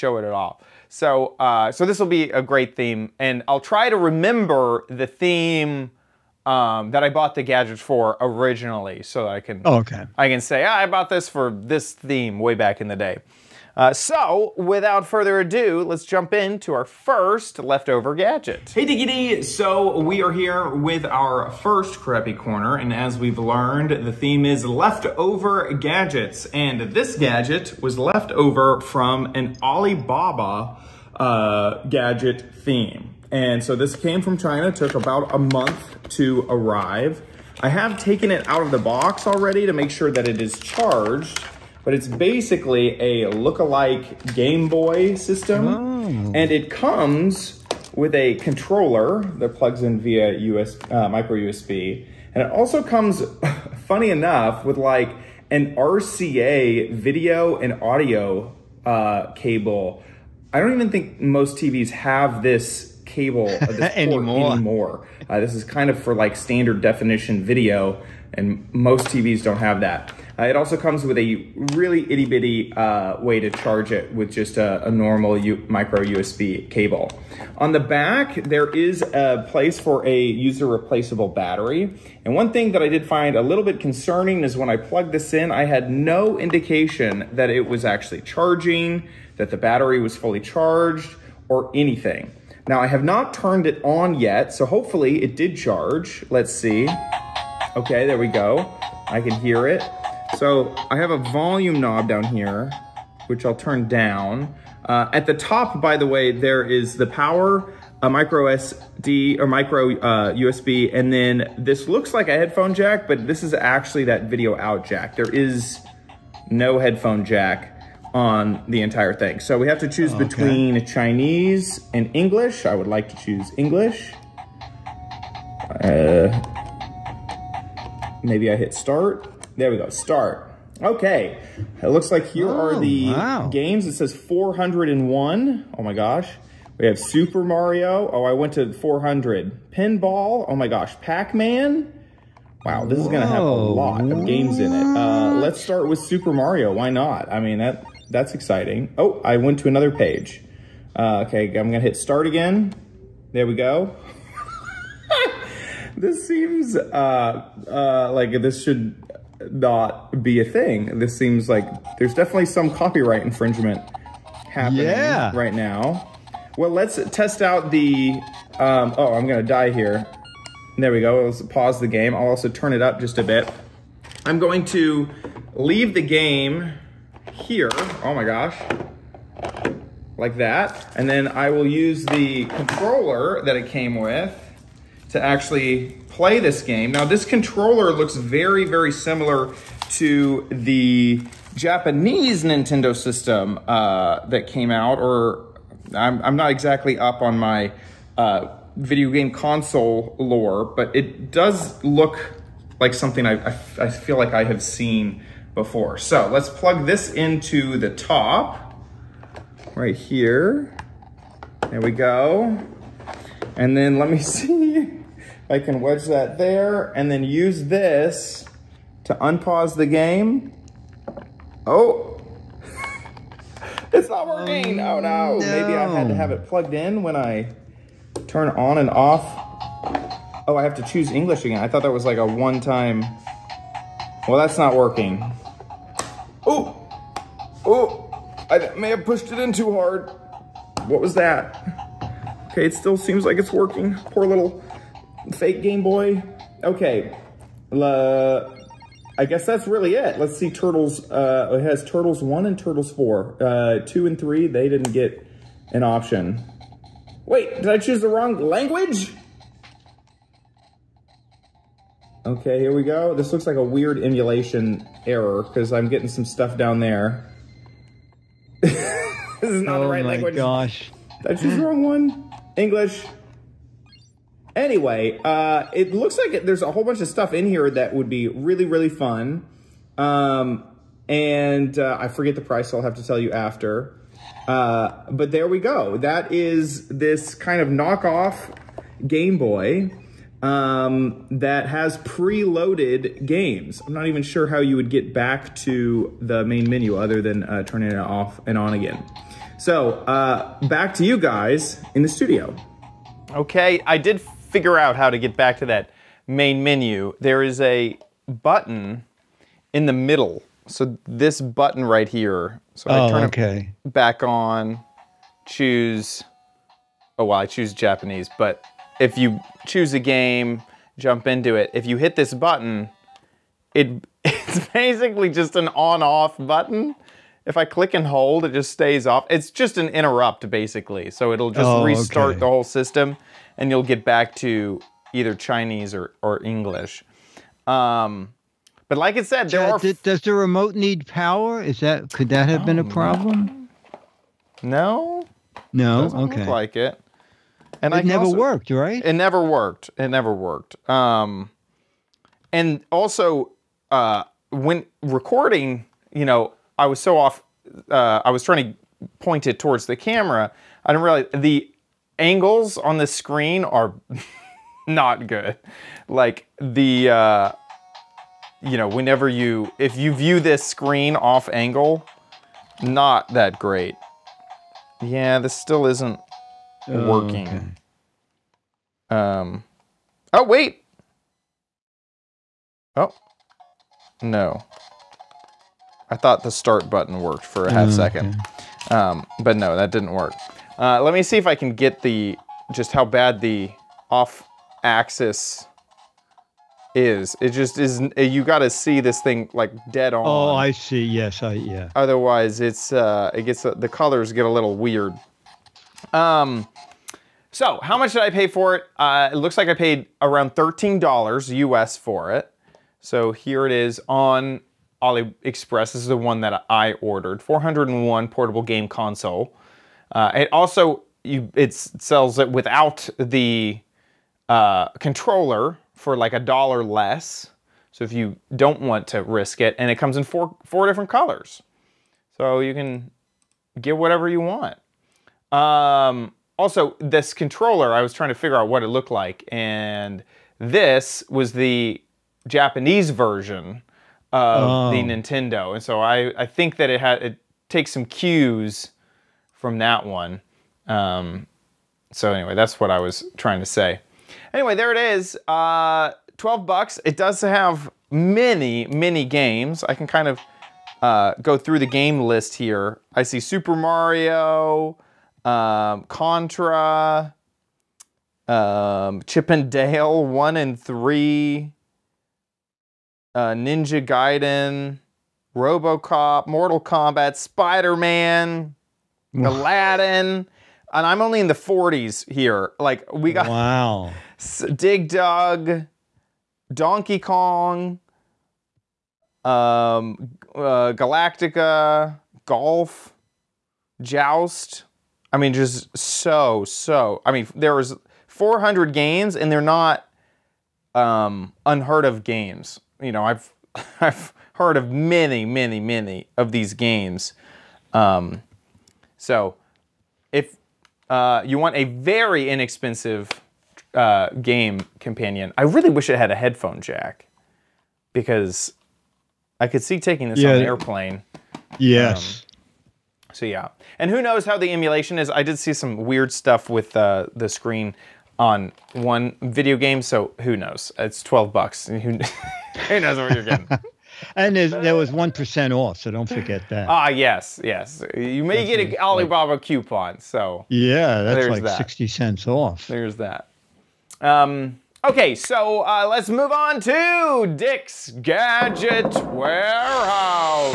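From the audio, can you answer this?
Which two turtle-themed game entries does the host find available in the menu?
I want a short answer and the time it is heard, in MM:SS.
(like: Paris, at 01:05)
Turtles 1 and Turtles 4, at 04:11.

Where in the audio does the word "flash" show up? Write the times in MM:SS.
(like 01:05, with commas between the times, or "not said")
not said.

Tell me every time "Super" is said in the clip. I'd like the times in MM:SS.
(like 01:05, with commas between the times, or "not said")
02:16, 02:26, 07:43.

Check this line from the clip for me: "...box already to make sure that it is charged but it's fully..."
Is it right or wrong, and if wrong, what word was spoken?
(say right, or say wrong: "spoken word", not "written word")
wrong: "basically", not "fully".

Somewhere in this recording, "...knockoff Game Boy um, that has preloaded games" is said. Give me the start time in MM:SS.
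04:47.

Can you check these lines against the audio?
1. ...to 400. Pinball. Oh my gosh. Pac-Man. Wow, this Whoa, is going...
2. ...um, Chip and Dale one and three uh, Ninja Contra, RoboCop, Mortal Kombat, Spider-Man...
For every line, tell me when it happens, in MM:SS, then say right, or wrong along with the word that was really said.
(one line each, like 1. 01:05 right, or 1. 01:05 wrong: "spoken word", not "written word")
1. 02:18 right
2. 07:48 wrong: "Gaiden", not "Contra".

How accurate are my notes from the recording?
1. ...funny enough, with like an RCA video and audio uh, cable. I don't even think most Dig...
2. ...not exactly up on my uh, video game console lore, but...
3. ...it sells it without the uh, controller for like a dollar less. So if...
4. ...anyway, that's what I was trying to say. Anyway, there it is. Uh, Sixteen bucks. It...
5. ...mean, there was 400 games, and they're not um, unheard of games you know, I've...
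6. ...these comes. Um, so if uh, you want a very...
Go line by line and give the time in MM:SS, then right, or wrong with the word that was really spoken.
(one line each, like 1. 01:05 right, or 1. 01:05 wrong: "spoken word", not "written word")
1. 00:53 wrong: "TVs", not "Dig"
2. 03:16 right
3. 07:01 right
4. 07:32 wrong: "Twelve", not "Sixteen"
5. 08:17 right
6. 08:26 wrong: "games", not "comes".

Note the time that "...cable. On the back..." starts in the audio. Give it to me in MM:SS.
01:16.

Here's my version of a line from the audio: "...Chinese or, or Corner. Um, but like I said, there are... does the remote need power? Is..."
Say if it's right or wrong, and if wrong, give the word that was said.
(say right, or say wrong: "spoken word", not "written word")
wrong: "English", not "Corner".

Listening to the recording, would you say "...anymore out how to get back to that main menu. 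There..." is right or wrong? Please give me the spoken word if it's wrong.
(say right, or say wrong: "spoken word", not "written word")
wrong: "figure", not "anymore".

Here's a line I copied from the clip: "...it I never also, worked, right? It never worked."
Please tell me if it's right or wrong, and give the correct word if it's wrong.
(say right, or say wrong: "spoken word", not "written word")
right.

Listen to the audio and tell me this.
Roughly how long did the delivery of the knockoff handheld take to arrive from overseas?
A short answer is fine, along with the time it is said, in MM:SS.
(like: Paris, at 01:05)
About a month, at 00:34.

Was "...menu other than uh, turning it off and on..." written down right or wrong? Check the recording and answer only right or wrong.
right.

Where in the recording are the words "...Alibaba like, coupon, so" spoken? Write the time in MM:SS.
08:58.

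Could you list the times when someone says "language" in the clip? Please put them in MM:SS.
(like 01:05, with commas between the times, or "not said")
04:18, 04:30.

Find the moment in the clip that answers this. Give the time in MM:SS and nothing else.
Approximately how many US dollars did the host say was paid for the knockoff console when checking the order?
06:50.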